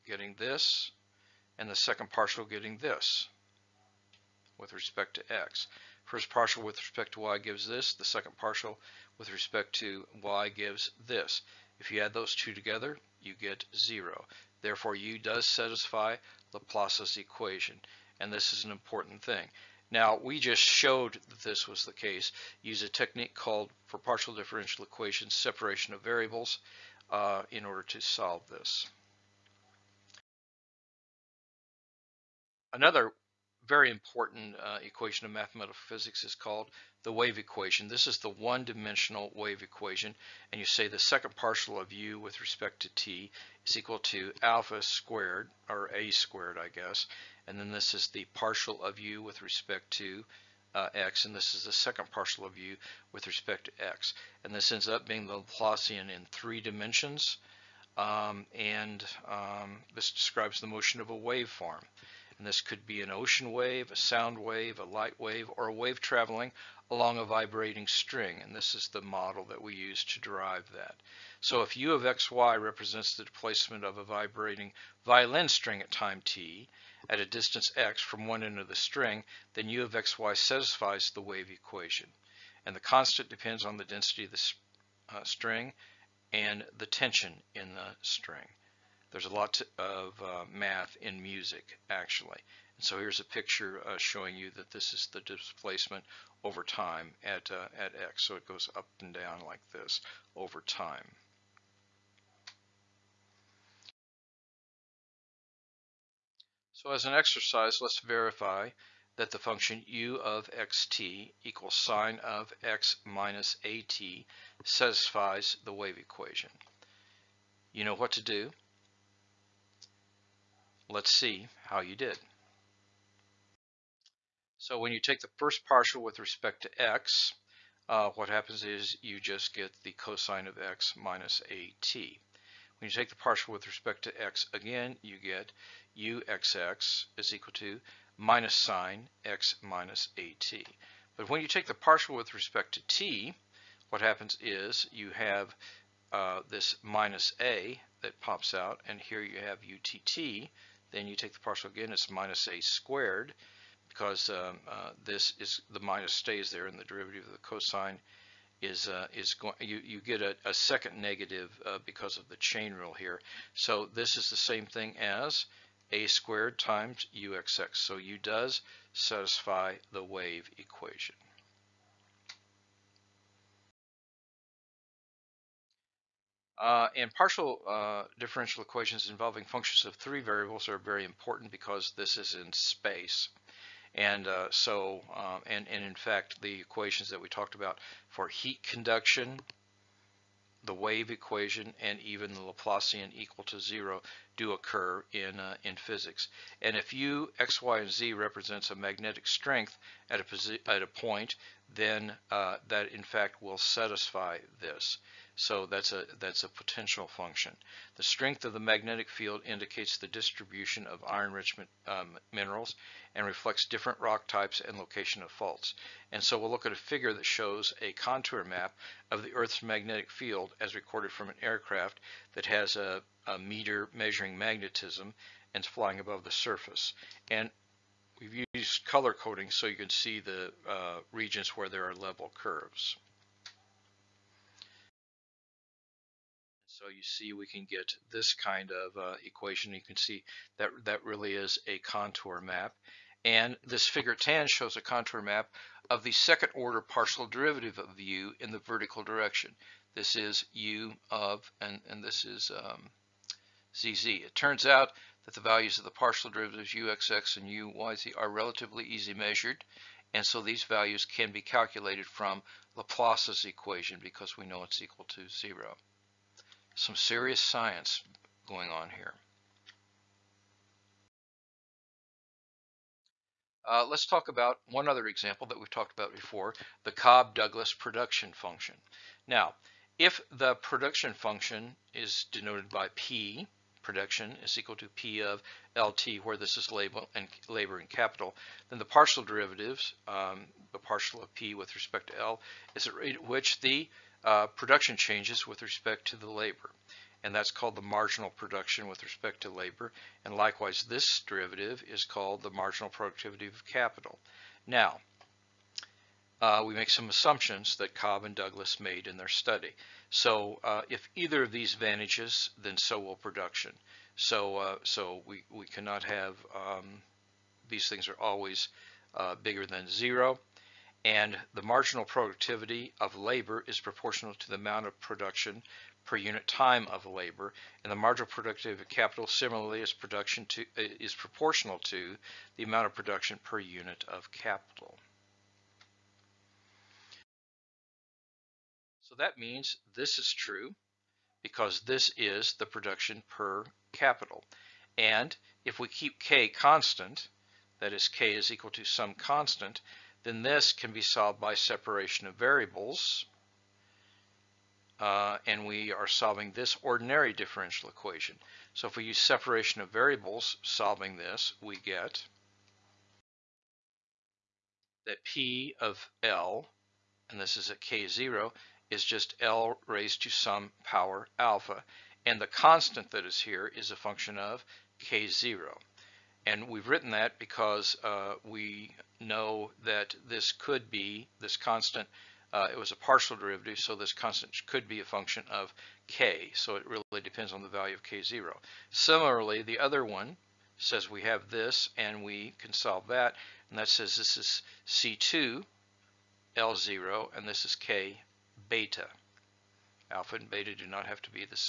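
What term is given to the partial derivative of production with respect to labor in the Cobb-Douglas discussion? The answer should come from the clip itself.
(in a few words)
Marginal production with respect to labor.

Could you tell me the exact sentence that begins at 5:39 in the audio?
So that means this is true because this is the production per capital.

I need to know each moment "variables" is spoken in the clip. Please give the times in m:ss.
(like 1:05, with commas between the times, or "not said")
0:26, 3:00, 5:52, 5:59.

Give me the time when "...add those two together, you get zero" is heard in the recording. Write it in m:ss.
0:12.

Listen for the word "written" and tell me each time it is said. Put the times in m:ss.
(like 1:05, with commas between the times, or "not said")
6:16.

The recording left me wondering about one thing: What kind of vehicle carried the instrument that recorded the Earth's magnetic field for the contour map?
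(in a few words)
Aircraft.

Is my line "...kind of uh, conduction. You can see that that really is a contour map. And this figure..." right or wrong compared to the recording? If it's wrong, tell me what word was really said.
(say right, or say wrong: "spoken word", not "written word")
wrong: "equation", not "conduction".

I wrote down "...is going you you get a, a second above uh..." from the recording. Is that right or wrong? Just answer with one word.
wrong.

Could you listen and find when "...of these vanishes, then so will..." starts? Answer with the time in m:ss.
5:11.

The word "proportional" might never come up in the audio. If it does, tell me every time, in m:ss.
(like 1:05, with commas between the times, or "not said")
5:23, 5:31.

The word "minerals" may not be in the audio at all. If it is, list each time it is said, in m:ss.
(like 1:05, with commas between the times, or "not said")
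3:32.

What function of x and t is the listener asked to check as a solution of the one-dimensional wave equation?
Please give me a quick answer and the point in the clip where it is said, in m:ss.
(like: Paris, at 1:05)
sine of x minus at, at 1:51.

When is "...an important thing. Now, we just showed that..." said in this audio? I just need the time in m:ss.
0:18.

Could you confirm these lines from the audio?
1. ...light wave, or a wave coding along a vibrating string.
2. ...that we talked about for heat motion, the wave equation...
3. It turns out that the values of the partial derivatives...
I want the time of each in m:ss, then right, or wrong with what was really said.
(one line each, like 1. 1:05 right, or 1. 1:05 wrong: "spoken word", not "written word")
1. 1:04 wrong: "traveling", not "coding"
2. 3:07 wrong: "conduction", not "motion"
3. 4:14 right.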